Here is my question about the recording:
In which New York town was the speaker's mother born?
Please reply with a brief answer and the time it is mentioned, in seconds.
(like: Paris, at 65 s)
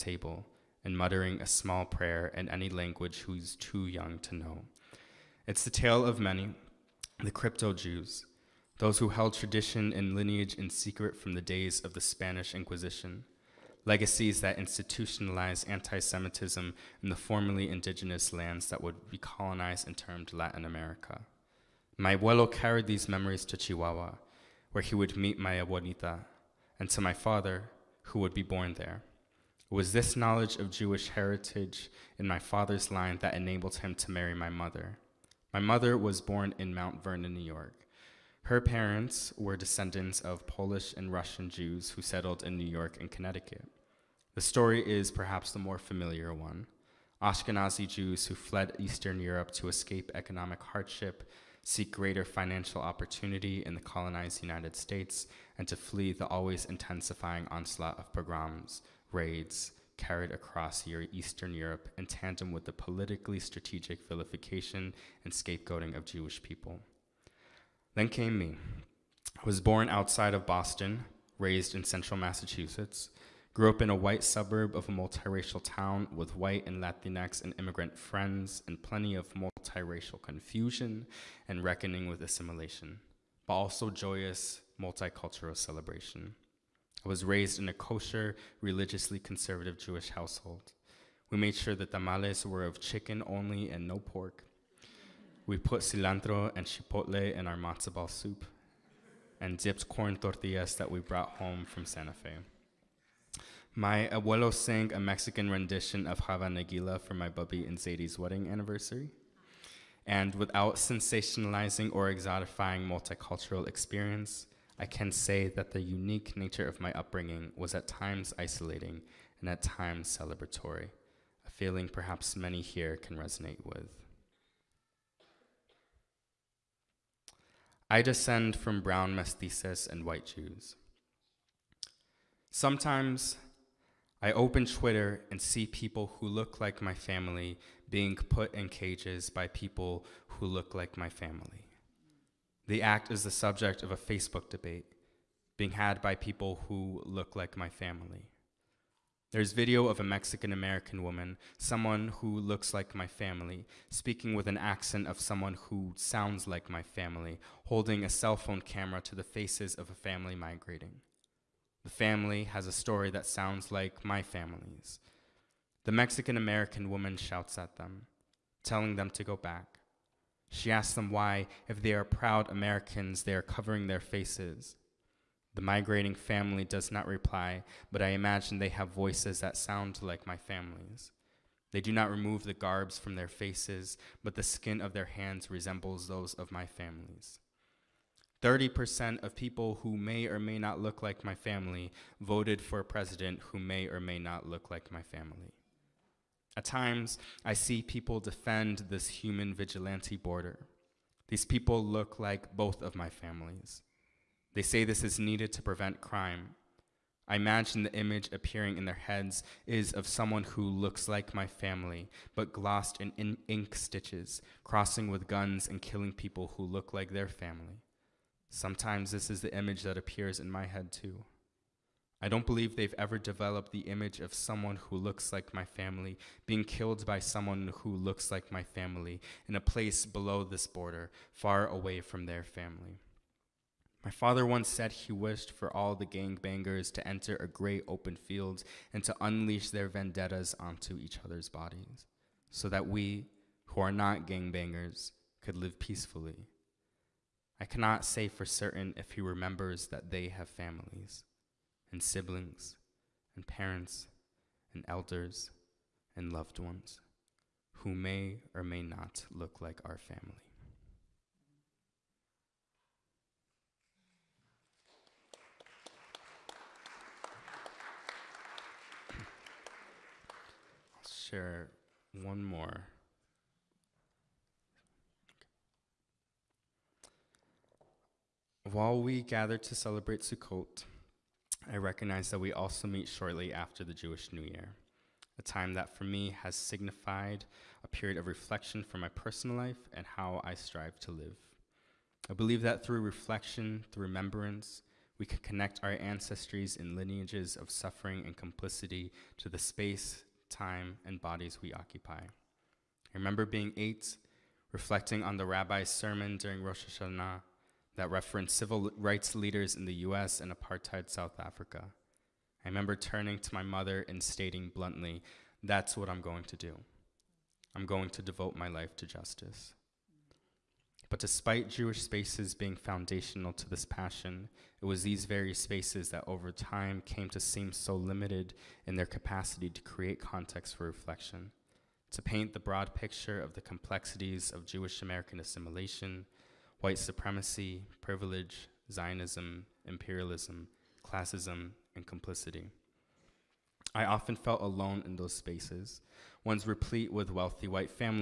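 Mount Vernon, at 36 s.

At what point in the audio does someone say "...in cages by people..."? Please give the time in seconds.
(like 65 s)
138 s.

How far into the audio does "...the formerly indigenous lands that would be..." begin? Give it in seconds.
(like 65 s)
17 s.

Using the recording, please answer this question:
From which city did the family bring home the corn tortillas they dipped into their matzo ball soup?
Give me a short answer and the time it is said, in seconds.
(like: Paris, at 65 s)
Santa Fe, at 101 s.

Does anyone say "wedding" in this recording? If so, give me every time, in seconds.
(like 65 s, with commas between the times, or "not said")
108 s.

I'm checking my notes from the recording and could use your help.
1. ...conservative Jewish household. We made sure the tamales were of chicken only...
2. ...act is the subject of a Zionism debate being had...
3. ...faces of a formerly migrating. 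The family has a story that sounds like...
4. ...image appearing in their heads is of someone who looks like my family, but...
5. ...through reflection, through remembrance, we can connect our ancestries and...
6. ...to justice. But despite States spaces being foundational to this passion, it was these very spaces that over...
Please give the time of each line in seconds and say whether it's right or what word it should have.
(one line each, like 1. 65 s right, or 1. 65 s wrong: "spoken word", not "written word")
1. 89 s right
2. 142 s wrong: "Facebook", not "Zionism"
3. 159 s wrong: "family", not "formerly"
4. 207 s right
5. 292 s right
6. 318 s wrong: "Jewish", not "States".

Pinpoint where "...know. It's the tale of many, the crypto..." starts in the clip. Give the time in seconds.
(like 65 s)
4 s.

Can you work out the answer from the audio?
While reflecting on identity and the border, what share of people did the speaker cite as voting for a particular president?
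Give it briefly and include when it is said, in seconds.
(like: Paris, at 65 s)
30%, at 188 s.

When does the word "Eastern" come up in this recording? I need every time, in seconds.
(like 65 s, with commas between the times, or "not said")
48 s, 61 s.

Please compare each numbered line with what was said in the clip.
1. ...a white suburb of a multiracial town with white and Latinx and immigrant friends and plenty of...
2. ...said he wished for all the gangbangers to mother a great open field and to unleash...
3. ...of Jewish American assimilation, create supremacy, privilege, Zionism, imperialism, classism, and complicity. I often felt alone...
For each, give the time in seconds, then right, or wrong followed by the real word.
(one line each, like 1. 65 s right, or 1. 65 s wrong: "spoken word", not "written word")
1. 73 s right
2. 234 s wrong: "enter", not "mother"
3. 334 s wrong: "white", not "create".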